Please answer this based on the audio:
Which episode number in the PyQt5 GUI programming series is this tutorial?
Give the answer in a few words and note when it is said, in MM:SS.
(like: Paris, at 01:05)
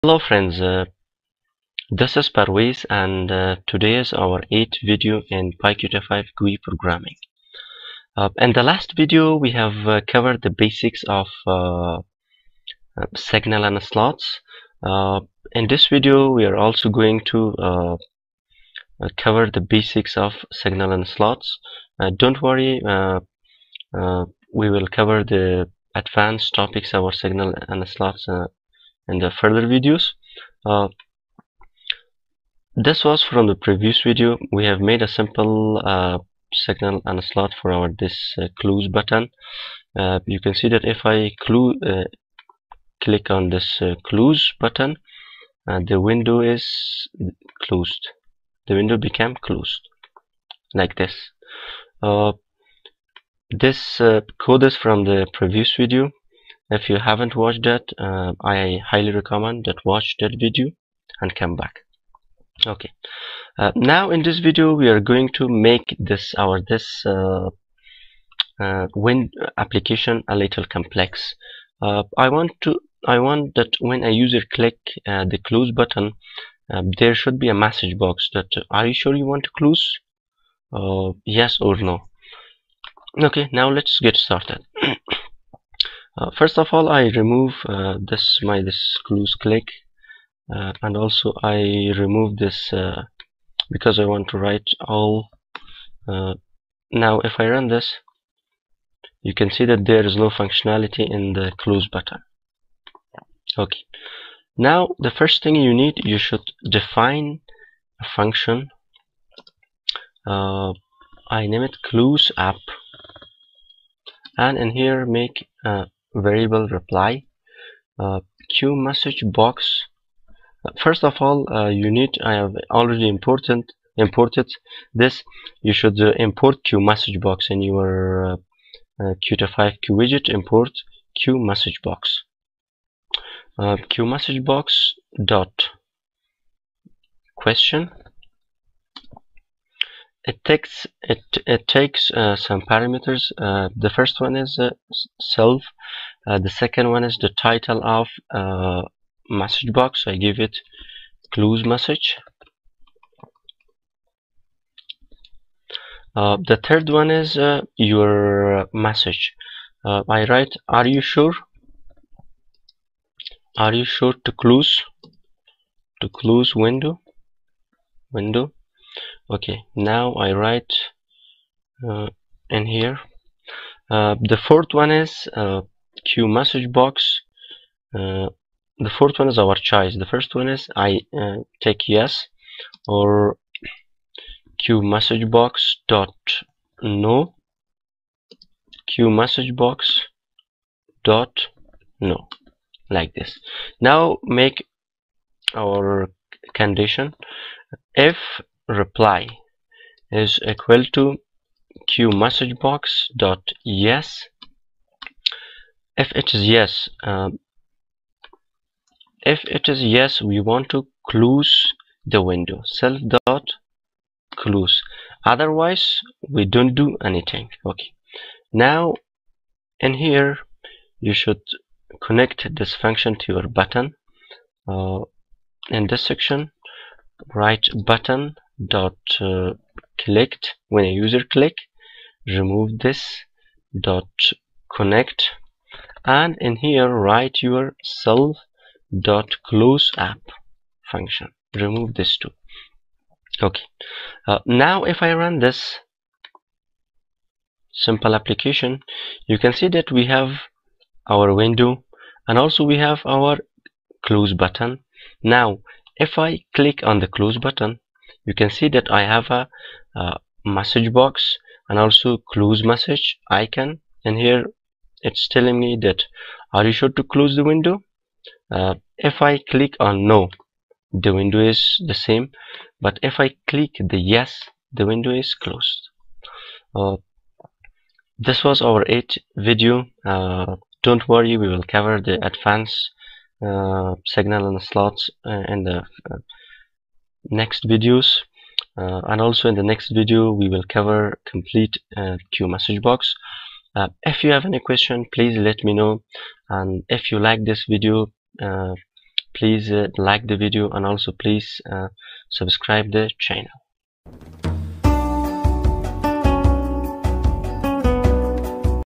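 8th, at 00:04.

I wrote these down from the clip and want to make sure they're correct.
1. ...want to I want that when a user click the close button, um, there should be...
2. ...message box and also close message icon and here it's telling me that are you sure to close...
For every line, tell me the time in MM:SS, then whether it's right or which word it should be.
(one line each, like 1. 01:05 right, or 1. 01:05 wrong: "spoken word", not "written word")
1. 01:12 right
2. 04:20 right.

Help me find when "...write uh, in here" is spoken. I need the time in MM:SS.
02:50.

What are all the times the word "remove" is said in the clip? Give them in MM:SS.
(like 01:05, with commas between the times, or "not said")
01:27, 01:31, 03:52, 04:01.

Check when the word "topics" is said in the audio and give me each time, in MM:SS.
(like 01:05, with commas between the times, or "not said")
00:26.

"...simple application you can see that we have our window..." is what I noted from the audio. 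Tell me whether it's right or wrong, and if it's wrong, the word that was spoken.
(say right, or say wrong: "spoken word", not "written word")
right.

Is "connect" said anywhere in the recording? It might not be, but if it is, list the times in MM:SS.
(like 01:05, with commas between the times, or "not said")
03:42, 03:54.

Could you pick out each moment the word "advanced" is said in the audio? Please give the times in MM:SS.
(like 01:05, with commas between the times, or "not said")
00:25, 04:42.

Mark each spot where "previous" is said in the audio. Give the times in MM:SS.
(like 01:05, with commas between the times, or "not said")
00:33, 00:55.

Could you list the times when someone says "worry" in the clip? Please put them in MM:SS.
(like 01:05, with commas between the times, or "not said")
00:22, 04:41.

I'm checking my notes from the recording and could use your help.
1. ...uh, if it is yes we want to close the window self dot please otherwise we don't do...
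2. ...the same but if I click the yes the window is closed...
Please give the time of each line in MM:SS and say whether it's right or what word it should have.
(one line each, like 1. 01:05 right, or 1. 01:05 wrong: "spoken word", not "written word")
1. 03:27 wrong: "close", not "please"
2. 04:31 right.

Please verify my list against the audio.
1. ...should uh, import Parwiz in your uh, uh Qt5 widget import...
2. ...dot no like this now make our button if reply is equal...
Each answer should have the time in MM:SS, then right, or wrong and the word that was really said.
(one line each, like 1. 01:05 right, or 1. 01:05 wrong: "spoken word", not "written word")
1. 02:05 wrong: "QMessageBox", not "Parwiz"
2. 03:11 wrong: "condition", not "button".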